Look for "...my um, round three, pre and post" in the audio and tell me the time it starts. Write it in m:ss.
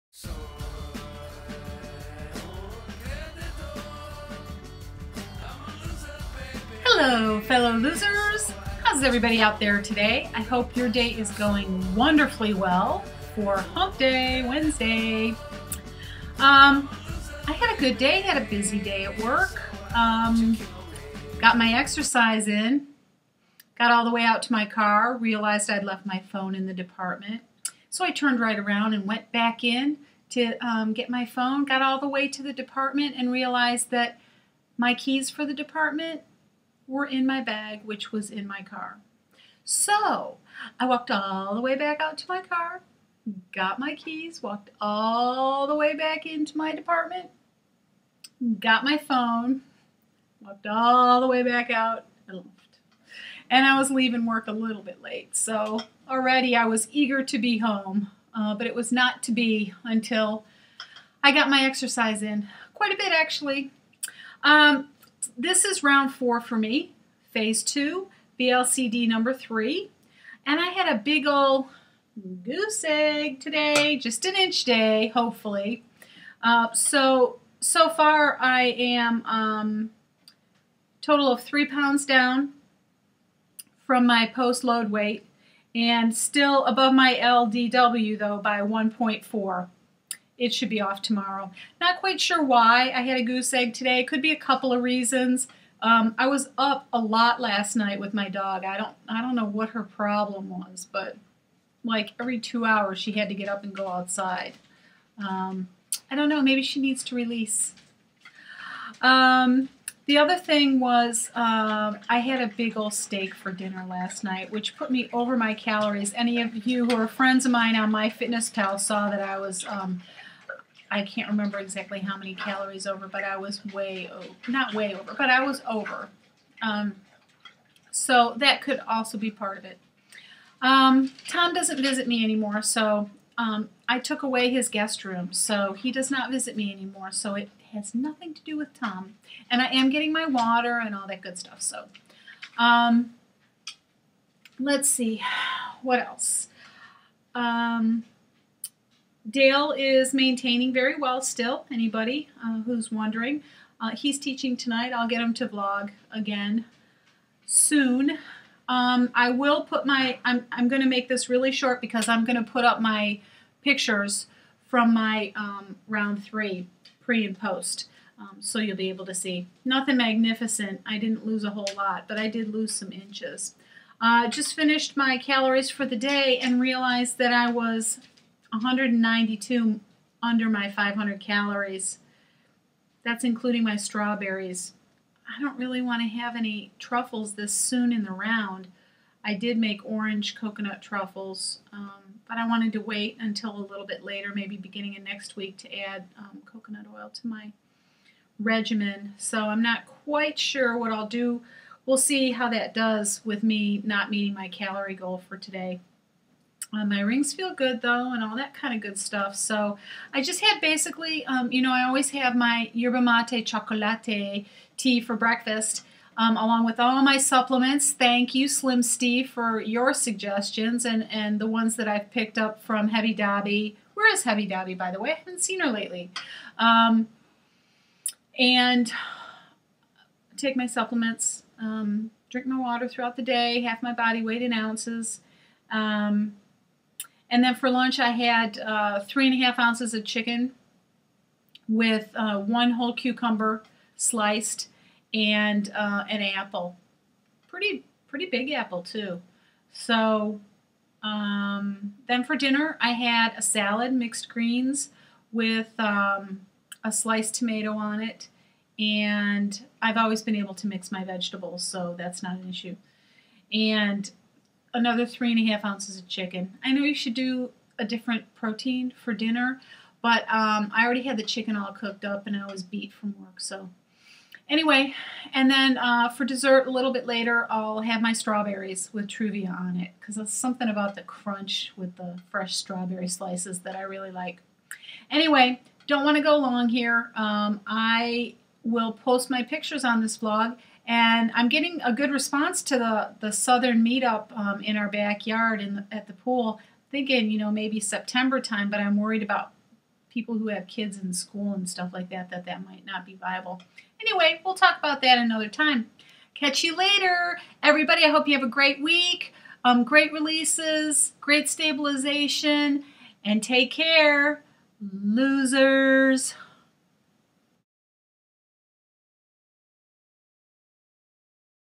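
2:44.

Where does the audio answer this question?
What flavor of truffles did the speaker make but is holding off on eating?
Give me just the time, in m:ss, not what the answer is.
3:09.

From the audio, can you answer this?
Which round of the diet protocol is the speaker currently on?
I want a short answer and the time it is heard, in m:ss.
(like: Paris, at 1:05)
4, at 1:05.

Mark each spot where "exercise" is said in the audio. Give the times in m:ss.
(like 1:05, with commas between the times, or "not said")
0:21, 1:01.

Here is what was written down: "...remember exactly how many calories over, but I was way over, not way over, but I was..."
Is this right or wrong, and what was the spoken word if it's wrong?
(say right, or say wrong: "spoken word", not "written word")
right.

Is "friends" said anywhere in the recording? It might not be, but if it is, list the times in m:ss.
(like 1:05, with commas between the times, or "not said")
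1:57.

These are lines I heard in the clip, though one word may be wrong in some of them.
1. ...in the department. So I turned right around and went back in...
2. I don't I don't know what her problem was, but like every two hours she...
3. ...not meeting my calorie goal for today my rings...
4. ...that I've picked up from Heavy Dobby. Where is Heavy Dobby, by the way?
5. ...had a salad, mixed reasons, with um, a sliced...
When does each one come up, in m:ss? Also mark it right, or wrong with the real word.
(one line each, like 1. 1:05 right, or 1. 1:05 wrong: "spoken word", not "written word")
1. 0:26 right
2. 1:38 right
3. 3:23 right
4. 3:41 right
5. 4:12 wrong: "greens", not "reasons".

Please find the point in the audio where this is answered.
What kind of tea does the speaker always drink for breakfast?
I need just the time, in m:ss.
3:32.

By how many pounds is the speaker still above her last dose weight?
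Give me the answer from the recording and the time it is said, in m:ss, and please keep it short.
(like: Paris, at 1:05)
1.4, at 1:28.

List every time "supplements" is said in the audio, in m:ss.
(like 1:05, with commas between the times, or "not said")
3:37, 3:50.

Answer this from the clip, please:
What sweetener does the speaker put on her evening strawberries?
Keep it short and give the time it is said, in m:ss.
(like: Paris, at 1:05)
Truvia, at 4:39.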